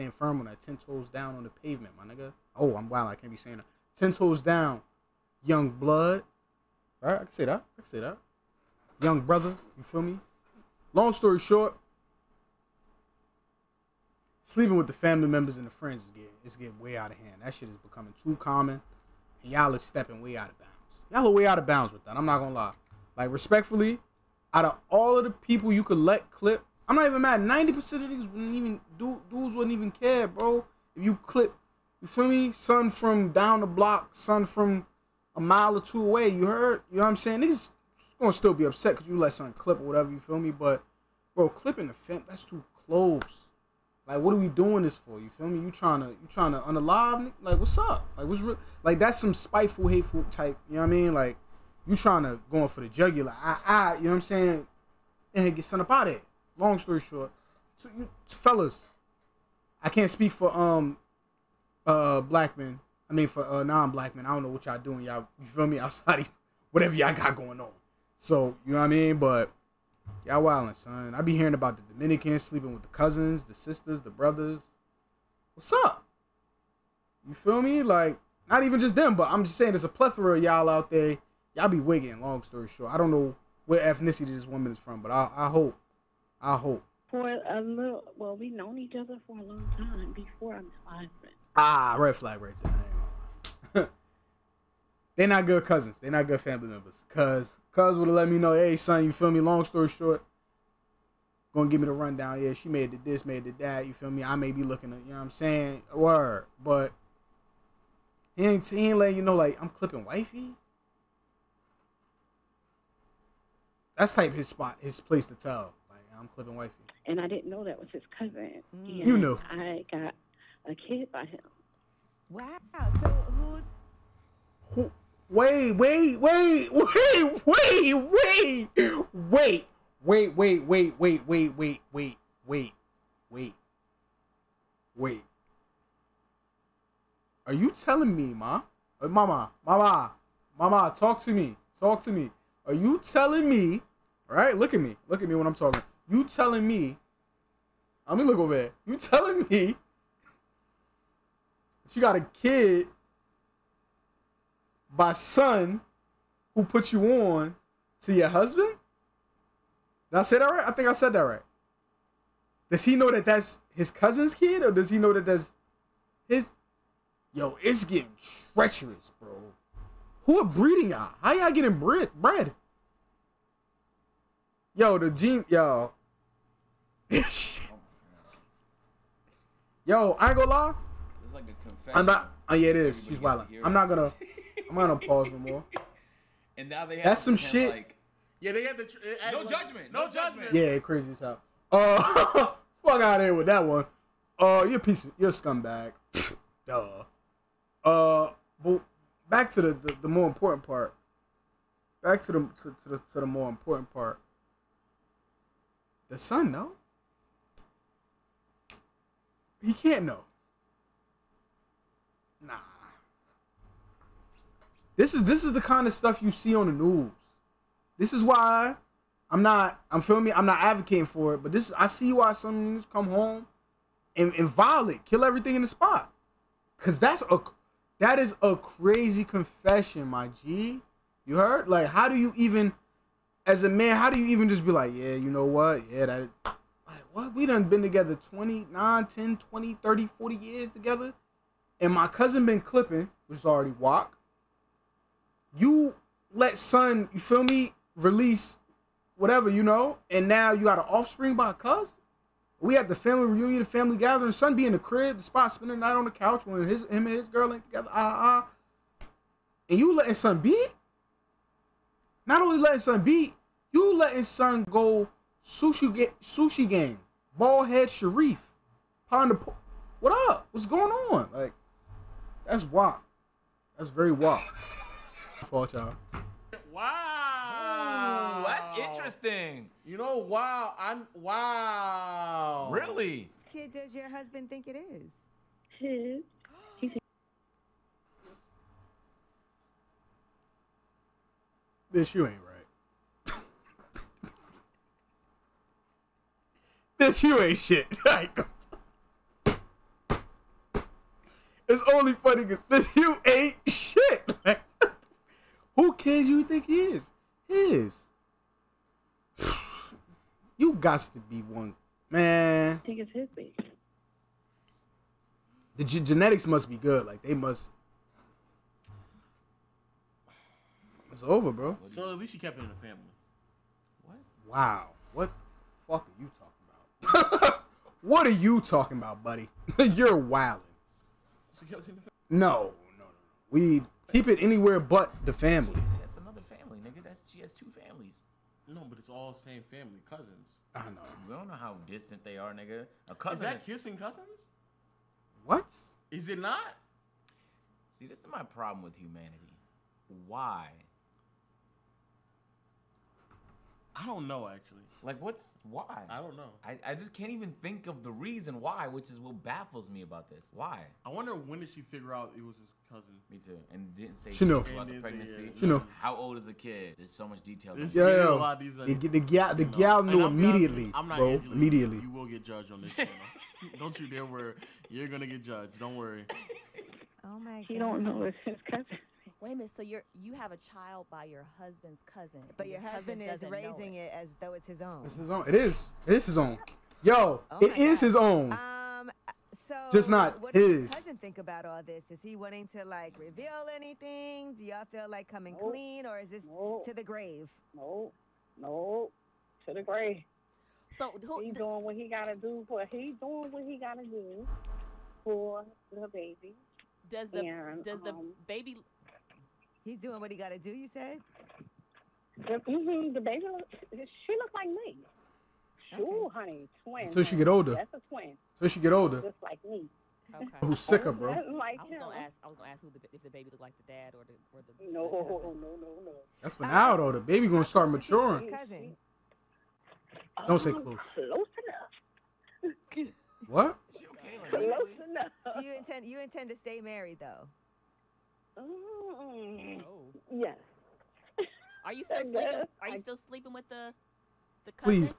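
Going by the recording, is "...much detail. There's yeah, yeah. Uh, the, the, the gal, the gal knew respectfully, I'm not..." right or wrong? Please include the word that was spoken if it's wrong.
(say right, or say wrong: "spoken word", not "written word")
wrong: "immediately", not "respectfully".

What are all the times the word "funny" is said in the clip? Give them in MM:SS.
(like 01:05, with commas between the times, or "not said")
05:02.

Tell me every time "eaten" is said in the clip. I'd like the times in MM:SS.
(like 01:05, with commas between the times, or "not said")
not said.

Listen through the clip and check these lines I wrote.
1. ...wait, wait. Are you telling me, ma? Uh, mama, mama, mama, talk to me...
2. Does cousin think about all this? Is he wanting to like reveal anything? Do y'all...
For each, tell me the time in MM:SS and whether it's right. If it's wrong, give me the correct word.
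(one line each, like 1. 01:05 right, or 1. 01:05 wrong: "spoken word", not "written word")
1. 02:13 right
2. 06:30 right.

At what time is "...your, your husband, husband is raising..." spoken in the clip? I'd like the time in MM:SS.
06:22.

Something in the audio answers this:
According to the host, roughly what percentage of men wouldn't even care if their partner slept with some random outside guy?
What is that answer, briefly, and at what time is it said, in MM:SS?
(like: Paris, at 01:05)
90%, at 00:27.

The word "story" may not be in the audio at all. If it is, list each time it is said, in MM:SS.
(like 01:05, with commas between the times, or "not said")
00:11, 00:56, 01:22, 01:39.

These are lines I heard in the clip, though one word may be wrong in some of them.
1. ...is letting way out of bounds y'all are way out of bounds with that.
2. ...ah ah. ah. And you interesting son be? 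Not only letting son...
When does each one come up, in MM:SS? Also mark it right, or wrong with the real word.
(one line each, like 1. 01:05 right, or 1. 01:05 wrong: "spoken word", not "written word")
1. 00:19 wrong: "stepping", not "letting"
2. 04:17 wrong: "letting", not "interesting".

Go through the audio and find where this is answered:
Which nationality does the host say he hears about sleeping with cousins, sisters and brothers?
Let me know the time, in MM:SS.
01:11.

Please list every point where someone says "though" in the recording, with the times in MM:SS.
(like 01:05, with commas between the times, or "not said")
06:24, 07:06, 07:17.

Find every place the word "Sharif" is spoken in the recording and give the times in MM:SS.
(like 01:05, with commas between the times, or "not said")
04:27.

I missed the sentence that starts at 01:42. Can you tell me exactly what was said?
Yeah, she made the this, made the that.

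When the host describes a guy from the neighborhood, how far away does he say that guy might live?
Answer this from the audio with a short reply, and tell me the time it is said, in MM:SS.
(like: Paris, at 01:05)
a mile or two, at 00:35.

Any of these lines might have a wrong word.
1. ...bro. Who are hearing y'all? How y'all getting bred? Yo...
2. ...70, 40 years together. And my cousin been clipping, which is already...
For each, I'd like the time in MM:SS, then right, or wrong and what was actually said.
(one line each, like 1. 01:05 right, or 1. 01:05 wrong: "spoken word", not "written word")
1. 02:49 wrong: "breeding", not "hearing"
2. 03:59 wrong: "30", not "70".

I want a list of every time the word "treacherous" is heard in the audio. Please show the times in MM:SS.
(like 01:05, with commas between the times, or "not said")
02:48.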